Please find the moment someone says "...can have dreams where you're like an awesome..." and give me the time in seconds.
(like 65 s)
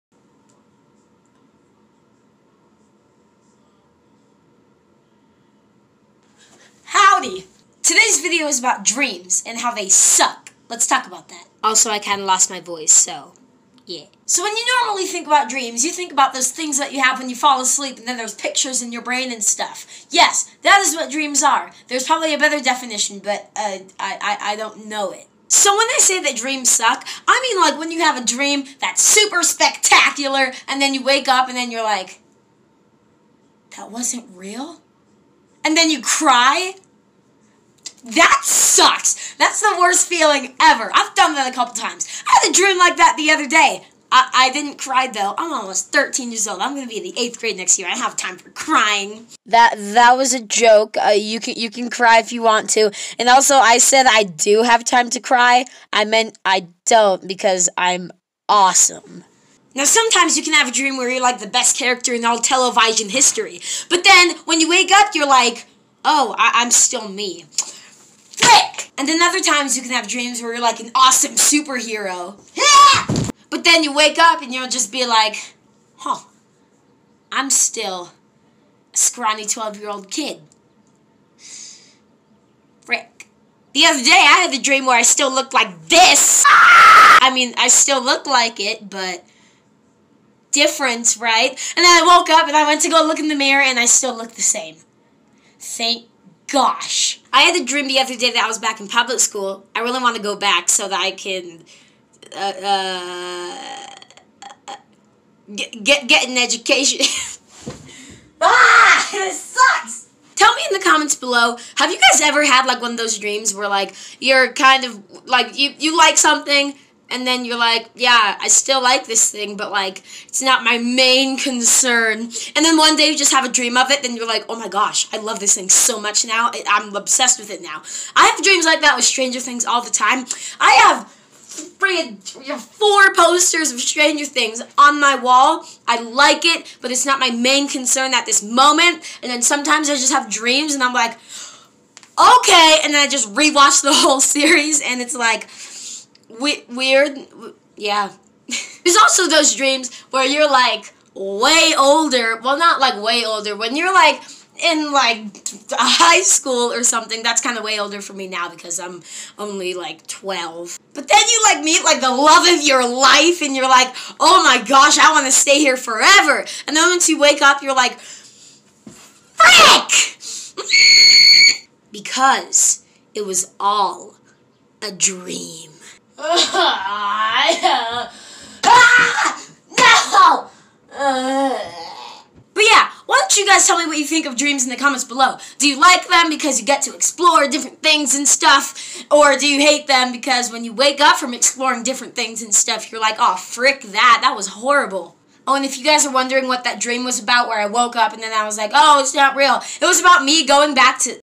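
69 s.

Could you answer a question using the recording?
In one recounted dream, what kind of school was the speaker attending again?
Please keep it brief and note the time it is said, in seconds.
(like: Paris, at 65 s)
public school, at 98 s.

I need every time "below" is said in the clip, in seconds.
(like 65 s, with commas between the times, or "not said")
111 s, 185 s.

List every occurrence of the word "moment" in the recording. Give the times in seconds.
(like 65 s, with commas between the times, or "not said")
138 s.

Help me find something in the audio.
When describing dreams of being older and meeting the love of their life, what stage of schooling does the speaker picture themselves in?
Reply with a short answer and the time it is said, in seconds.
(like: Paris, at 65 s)
high school, at 155 s.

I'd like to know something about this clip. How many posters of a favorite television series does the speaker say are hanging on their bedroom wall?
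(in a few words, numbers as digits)
4.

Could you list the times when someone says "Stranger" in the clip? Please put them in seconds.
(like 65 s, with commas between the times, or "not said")
129 s, 133 s.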